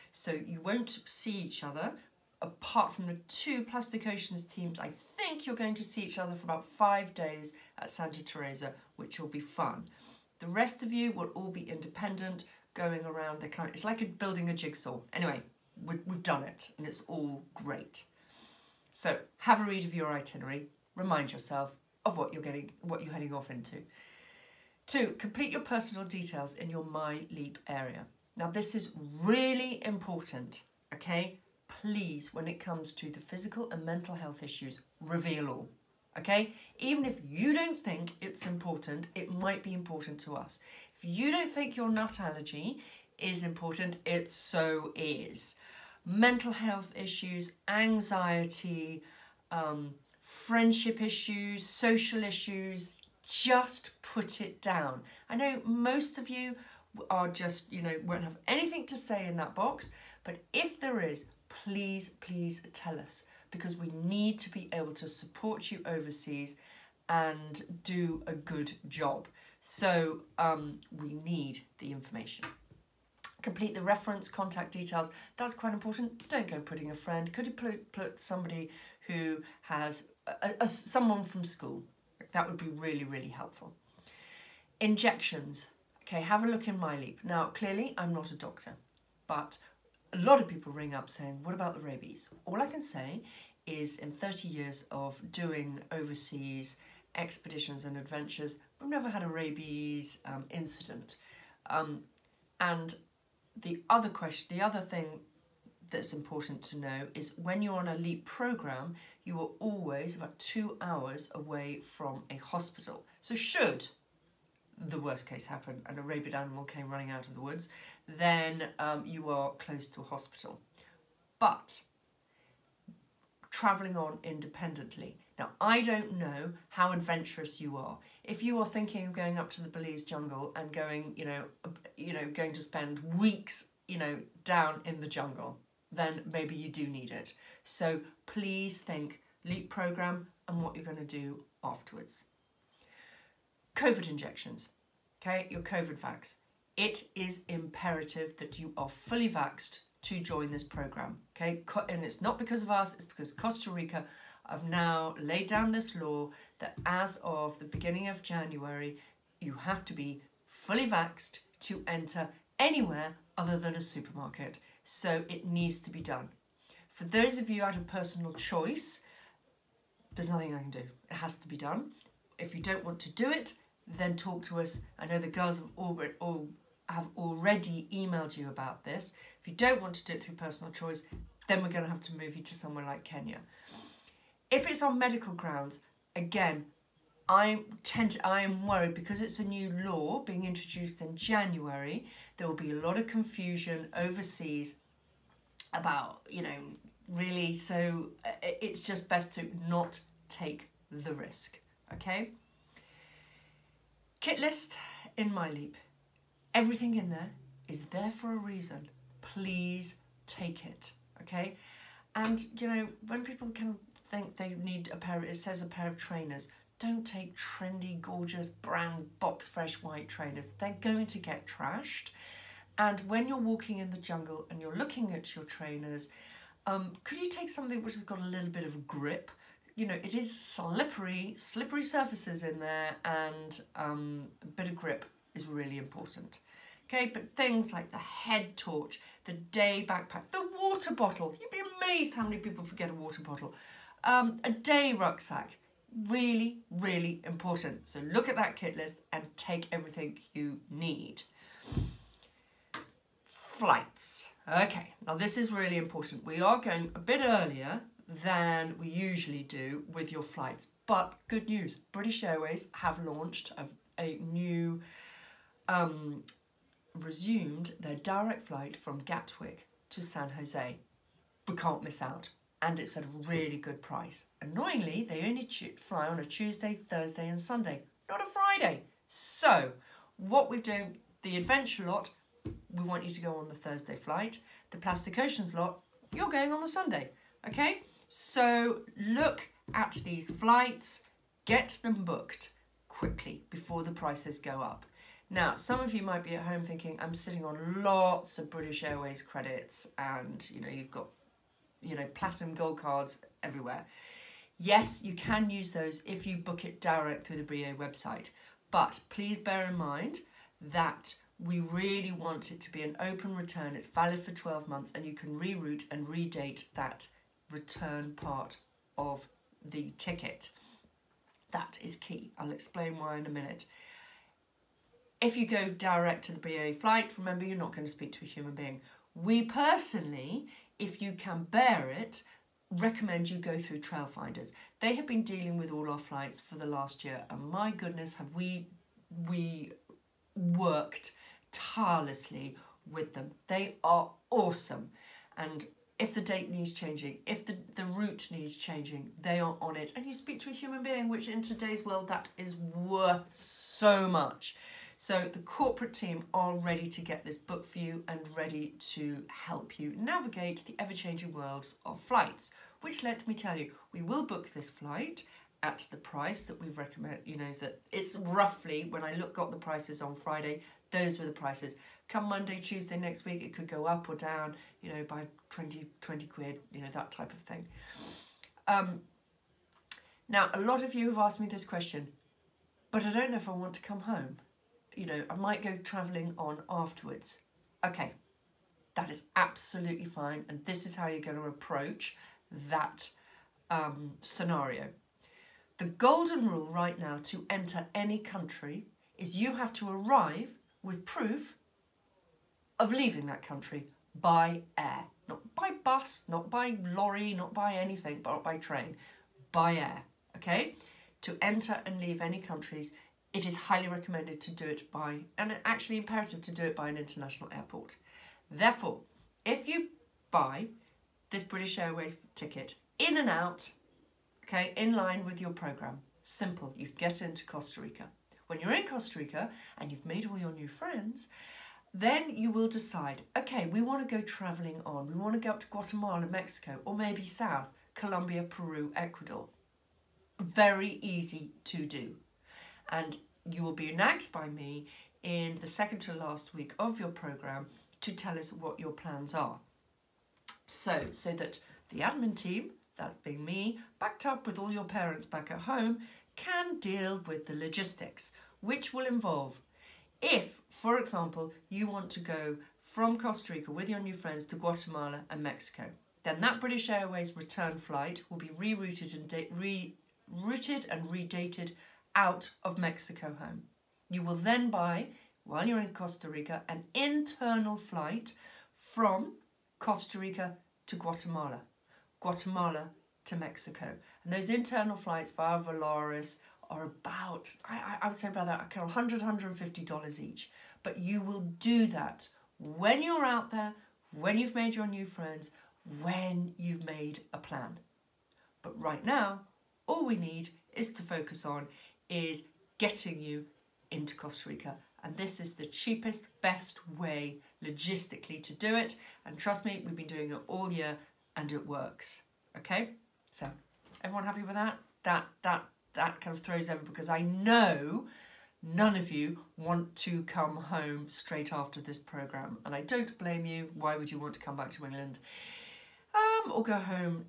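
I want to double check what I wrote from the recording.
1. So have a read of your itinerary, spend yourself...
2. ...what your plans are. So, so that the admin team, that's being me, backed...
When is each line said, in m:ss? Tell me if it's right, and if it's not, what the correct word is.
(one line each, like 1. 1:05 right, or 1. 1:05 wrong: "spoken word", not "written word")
1. 0:18 wrong: "remind", not "spend"
2. 7:28 right.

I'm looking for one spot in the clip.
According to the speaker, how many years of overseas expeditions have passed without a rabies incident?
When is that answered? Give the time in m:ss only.
1:34.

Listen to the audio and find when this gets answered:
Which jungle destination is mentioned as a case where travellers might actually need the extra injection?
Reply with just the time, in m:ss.
2:09.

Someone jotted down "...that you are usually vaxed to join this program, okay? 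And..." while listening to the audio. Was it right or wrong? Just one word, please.
wrong.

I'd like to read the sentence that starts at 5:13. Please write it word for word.
It's valid for 12 months and you can reroute and redate that return part of the ticket.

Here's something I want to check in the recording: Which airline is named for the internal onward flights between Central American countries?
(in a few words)
Volaris.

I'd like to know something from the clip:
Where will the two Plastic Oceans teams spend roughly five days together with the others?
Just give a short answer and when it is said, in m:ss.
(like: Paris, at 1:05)
Santa Teresa, at 0:07.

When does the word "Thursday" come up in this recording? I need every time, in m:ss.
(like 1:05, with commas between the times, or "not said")
4:36, 4:43.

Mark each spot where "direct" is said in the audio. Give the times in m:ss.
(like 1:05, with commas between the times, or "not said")
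4:27, 5:06, 5:25.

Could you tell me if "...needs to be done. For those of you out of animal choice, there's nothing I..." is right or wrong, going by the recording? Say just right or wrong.
wrong.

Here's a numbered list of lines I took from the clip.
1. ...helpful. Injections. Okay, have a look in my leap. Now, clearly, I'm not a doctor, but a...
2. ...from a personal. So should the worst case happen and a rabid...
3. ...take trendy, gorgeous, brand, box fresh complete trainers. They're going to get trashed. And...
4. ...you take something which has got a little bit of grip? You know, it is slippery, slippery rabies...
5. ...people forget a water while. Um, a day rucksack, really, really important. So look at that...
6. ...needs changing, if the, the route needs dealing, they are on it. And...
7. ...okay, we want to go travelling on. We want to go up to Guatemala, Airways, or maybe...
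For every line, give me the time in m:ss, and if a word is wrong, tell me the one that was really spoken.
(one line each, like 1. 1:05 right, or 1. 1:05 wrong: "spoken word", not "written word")
1. 1:23 right
2. 1:51 wrong: "hospital", not "personal"
3. 3:37 wrong: "white", not "complete"
4. 3:47 wrong: "surfaces", not "rabies"
5. 4:02 wrong: "bottle", not "while"
6. 5:46 wrong: "changing", not "dealing"
7. 7:13 wrong: "Mexico", not "Airways".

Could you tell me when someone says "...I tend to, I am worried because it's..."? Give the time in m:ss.
3:07.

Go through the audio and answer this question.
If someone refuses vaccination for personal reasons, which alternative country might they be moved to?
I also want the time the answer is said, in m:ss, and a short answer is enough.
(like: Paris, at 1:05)
Kenya, at 3:03.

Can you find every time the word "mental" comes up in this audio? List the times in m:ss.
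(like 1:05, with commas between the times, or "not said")
0:33, 0:46.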